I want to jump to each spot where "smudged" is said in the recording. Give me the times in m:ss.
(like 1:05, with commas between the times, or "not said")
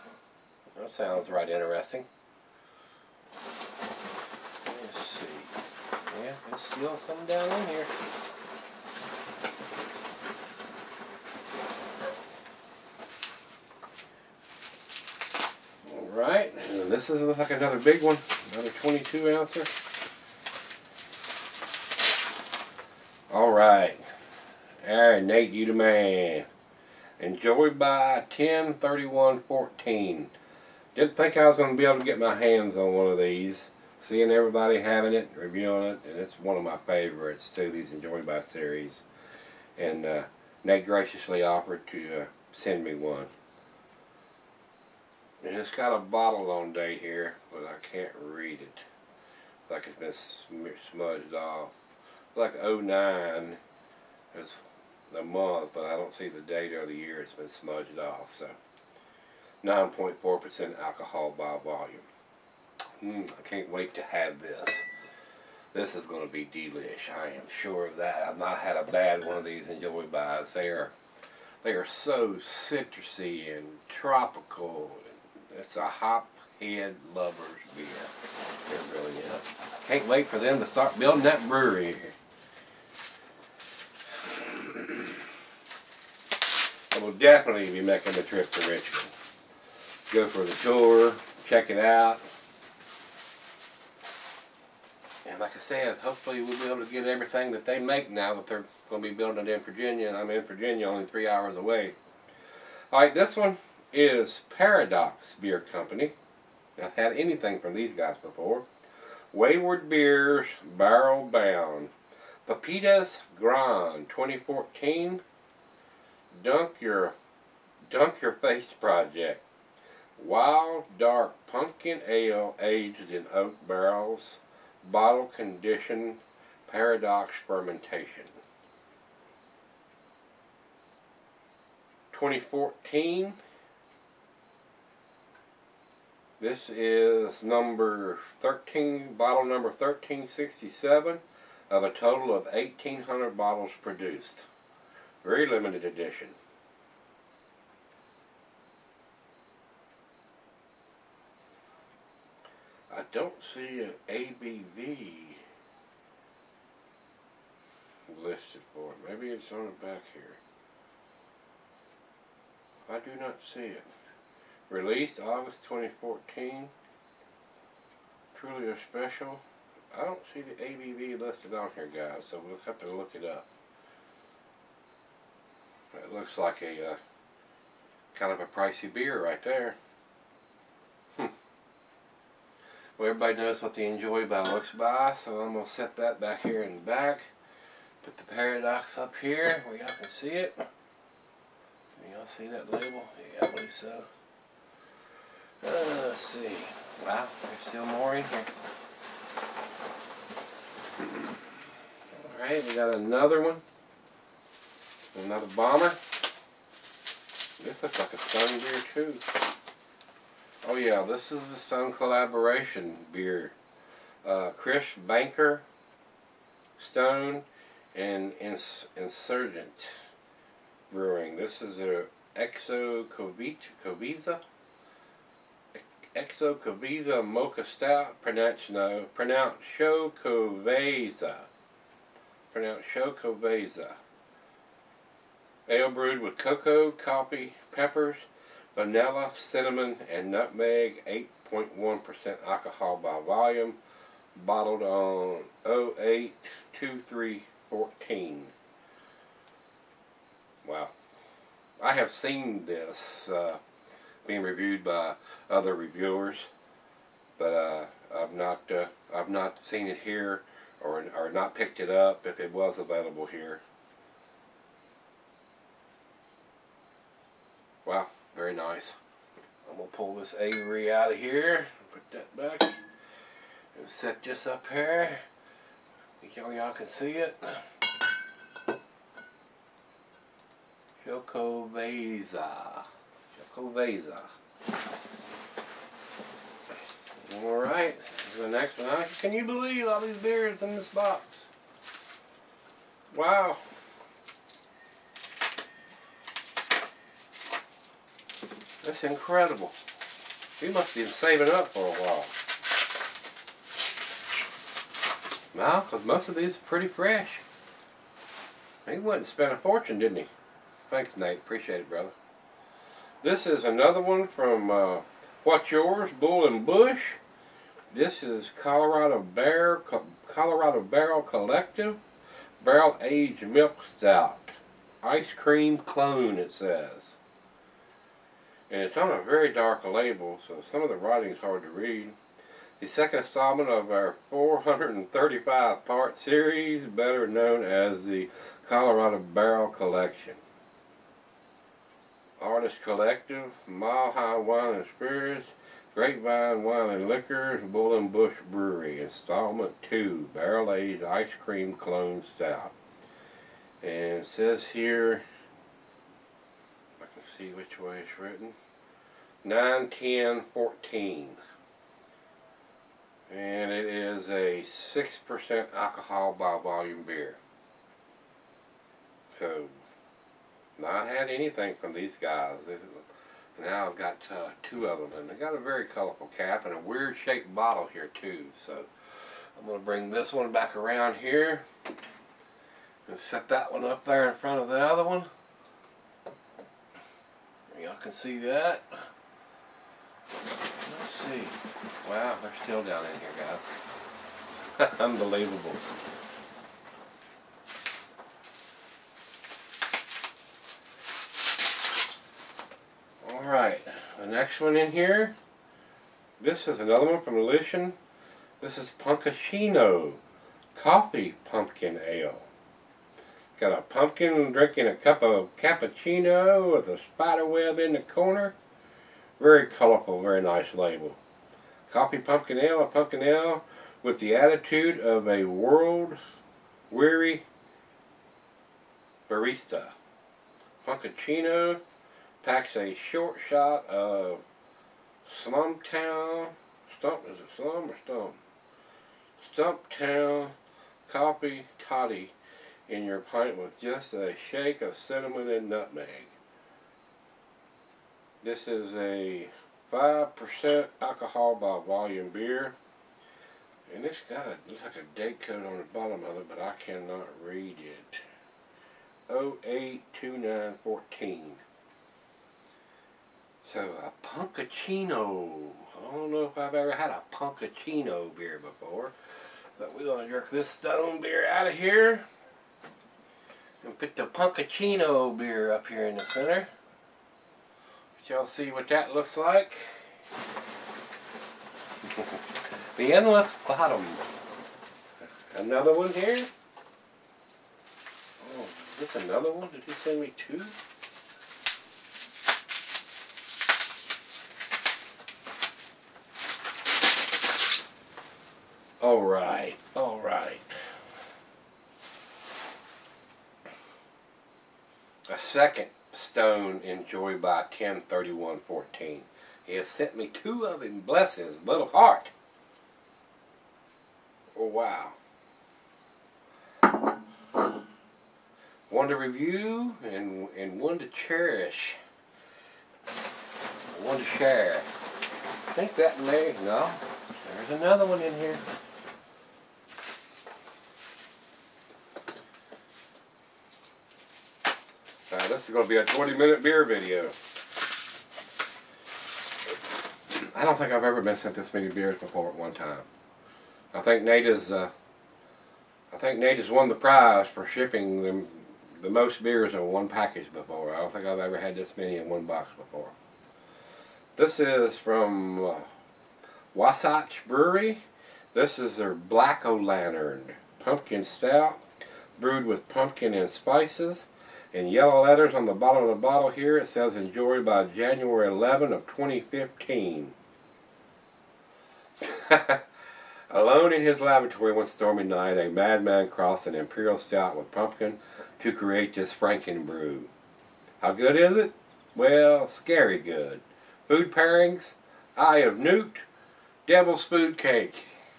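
0:50, 0:57.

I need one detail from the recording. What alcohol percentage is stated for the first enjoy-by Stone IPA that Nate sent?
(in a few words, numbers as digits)
9.4%.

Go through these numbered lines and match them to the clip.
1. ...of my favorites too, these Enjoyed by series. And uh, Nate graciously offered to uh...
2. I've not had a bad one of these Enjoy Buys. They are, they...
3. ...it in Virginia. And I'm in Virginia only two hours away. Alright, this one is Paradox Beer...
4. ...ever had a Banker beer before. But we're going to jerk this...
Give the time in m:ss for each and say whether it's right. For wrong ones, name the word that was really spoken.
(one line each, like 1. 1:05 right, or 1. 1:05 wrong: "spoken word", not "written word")
1. 0:36 right
2. 1:08 right
3. 1:39 wrong: "three", not "two"
4. 7:46 wrong: "Punkuccino", not "Banker".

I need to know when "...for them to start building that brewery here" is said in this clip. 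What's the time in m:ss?
1:20.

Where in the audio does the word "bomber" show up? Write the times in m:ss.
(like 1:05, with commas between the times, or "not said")
3:25.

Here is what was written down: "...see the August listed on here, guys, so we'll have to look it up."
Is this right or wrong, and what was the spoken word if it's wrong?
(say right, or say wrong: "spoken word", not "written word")
wrong: "ABV", not "August".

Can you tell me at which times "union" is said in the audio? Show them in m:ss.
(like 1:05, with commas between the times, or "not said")
not said.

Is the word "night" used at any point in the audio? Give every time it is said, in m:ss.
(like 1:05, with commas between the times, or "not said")
9:35.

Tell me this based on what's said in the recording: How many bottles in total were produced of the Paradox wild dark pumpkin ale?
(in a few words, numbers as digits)
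1,800.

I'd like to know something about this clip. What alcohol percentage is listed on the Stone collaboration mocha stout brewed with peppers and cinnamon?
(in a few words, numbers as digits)
8.1%.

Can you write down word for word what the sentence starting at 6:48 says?
This is Punkuccino Coffee Pumpkin Ale.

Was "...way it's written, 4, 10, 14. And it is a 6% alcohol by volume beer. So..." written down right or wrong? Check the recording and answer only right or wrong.
wrong.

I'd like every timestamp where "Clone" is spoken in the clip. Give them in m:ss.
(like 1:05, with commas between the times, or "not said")
5:25, 5:51.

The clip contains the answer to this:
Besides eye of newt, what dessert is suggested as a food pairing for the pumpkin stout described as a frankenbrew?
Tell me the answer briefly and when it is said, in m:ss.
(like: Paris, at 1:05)
Devil's Food Cake, at 9:46.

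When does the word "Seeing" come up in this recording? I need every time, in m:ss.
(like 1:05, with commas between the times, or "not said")
0:34.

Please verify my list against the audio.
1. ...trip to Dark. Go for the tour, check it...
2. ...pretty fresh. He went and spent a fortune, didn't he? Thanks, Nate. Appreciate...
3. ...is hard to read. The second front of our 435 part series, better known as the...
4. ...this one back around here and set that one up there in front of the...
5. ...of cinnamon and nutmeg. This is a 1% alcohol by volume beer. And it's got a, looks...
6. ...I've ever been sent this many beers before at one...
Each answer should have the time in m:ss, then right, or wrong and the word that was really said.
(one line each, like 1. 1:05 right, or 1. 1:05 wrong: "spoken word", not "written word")
1. 1:28 wrong: "Richmond", not "Dark"
2. 5:06 right
3. 5:31 wrong: "installment", not "front"
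4. 6:20 right
5. 7:24 wrong: "5", not "1"
6. 9:00 right.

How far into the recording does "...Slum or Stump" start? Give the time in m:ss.
7:17.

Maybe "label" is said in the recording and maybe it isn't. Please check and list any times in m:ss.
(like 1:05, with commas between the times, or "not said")
3:12, 5:29, 7:00.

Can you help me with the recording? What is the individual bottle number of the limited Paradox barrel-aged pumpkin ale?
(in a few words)
1367.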